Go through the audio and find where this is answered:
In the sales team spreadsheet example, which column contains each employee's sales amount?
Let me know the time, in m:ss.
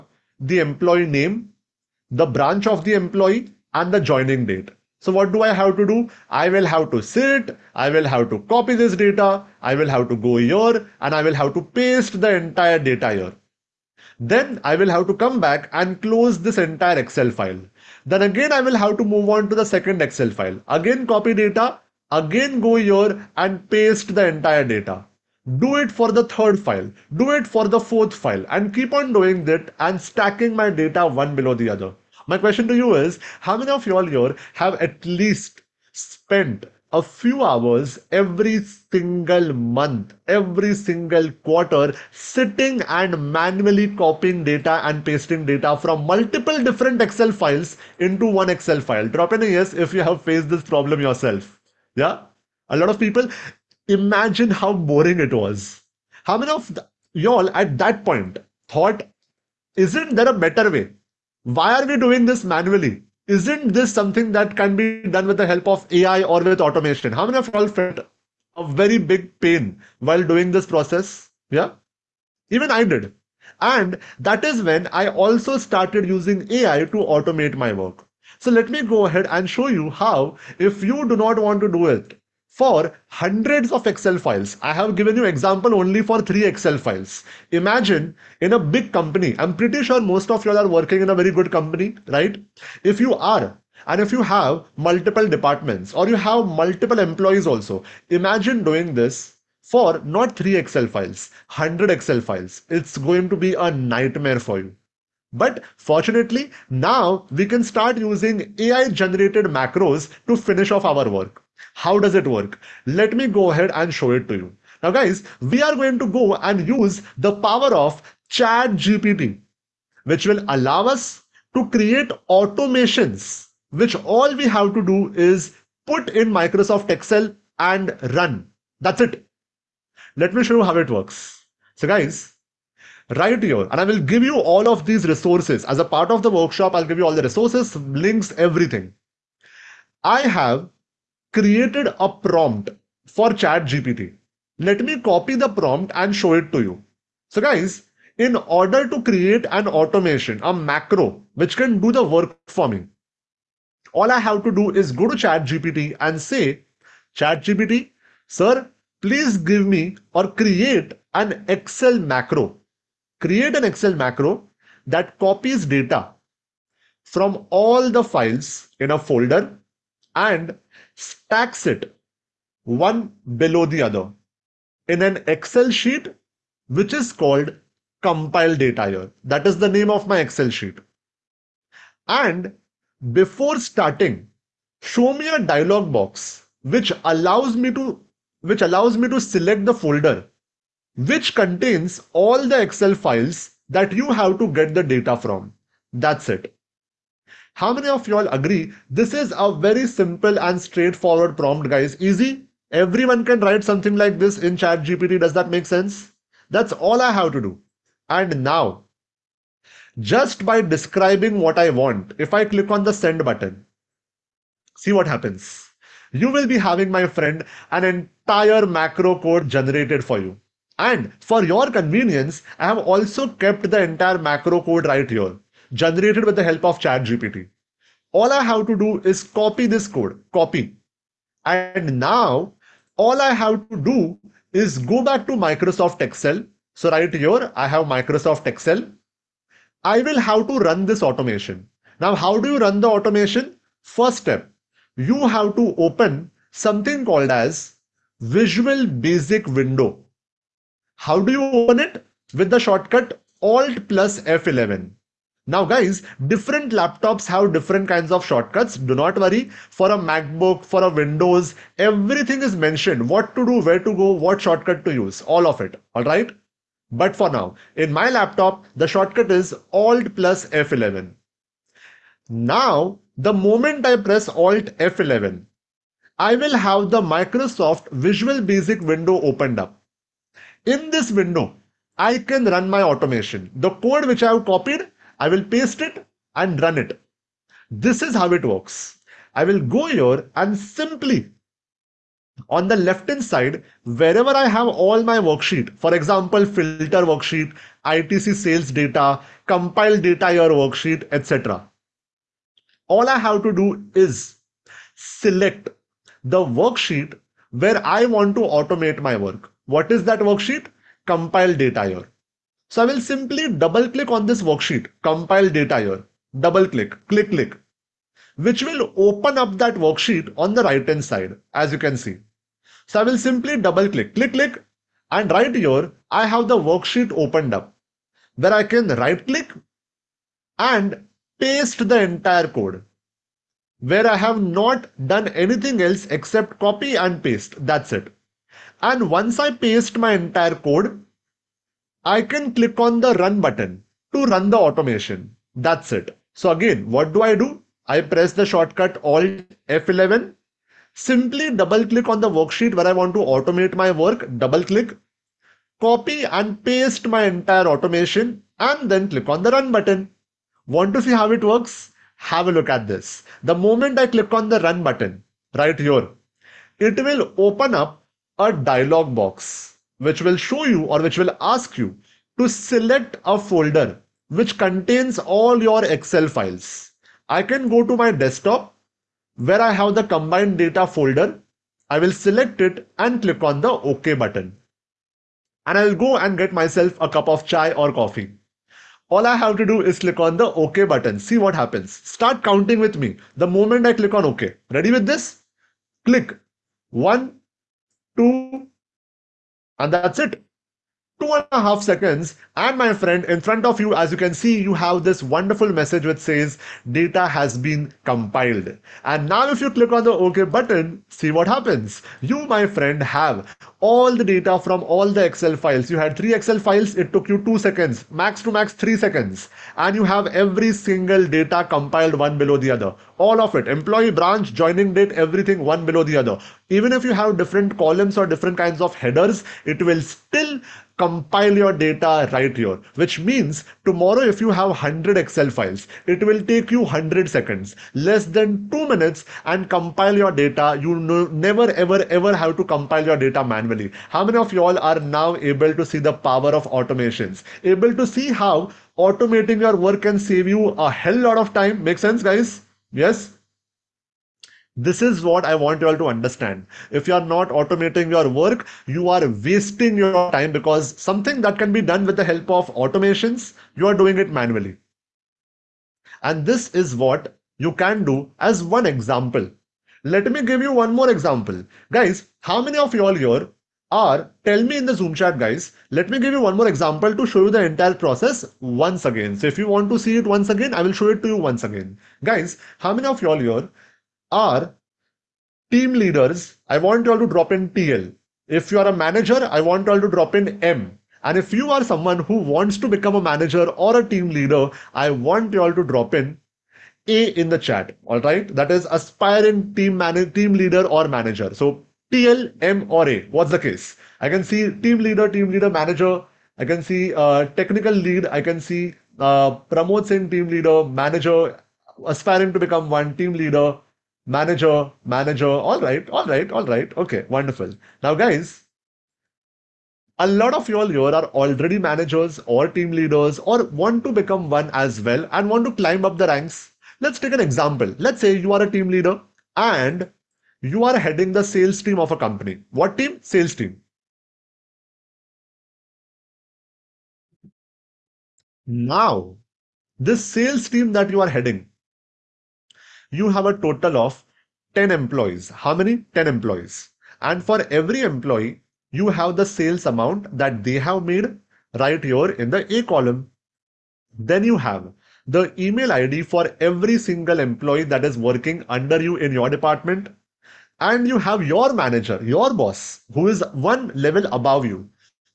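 9:12.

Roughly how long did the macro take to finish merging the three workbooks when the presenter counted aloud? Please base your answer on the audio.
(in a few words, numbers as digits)
two and a half seconds.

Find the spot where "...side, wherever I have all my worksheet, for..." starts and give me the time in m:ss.
4:53.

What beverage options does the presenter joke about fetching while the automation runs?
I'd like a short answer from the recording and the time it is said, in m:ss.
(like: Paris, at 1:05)
chai or coffee, at 6:27.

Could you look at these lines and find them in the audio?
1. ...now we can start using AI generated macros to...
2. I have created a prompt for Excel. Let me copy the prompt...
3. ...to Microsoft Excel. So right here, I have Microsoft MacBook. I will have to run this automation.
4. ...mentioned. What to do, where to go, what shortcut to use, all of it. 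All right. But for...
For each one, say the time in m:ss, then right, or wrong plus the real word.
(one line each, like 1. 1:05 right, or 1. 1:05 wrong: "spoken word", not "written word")
1. 1:46 right
2. 2:20 wrong: "ChatGPT", not "Excel"
3. 3:55 wrong: "Excel", not "MacBook"
4. 4:22 right.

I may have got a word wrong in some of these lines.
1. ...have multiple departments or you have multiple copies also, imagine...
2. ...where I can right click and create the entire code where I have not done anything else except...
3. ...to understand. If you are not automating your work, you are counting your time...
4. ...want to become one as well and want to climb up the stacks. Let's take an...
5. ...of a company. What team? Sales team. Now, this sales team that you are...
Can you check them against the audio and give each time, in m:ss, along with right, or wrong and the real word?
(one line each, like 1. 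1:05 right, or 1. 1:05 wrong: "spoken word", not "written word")
1. 1:34 wrong: "employees", not "copies"
2. 5:28 wrong: "paste", not "create"
3. 7:35 wrong: "wasting", not "counting"
4. 8:43 wrong: "ranks", not "stacks"
5. 8:51 right.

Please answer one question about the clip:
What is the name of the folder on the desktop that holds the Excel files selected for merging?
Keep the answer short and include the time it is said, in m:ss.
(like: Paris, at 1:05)
combined data, at 6:20.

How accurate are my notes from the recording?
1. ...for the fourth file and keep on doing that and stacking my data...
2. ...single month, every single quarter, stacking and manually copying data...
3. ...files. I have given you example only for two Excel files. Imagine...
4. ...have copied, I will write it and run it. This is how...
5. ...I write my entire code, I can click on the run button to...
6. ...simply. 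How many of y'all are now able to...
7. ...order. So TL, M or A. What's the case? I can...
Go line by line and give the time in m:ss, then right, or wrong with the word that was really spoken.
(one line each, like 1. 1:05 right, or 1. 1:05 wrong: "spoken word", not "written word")
1. 0:27 right
2. 0:38 wrong: "sitting", not "stacking"
3. 1:24 wrong: "three", not "two"
4. 4:44 wrong: "paste", not "write"
5. 5:39 wrong: "paste", not "write"
6. 7:23 wrong: "manually", not "simply"
7. 8:21 wrong: "manager", not "order".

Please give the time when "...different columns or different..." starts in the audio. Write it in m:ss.
7:07.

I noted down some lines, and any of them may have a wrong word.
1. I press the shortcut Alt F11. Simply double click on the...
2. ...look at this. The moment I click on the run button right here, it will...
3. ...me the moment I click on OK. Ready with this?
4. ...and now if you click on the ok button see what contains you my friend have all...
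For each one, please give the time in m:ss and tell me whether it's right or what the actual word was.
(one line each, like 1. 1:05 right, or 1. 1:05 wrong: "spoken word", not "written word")
1. 5:47 right
2. 6:02 right
3. 6:32 right
4. 6:49 wrong: "happens", not "contains".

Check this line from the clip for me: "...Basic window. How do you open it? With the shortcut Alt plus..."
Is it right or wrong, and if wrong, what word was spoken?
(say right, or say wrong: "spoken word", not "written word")
right.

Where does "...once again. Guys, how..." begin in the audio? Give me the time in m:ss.
8:01.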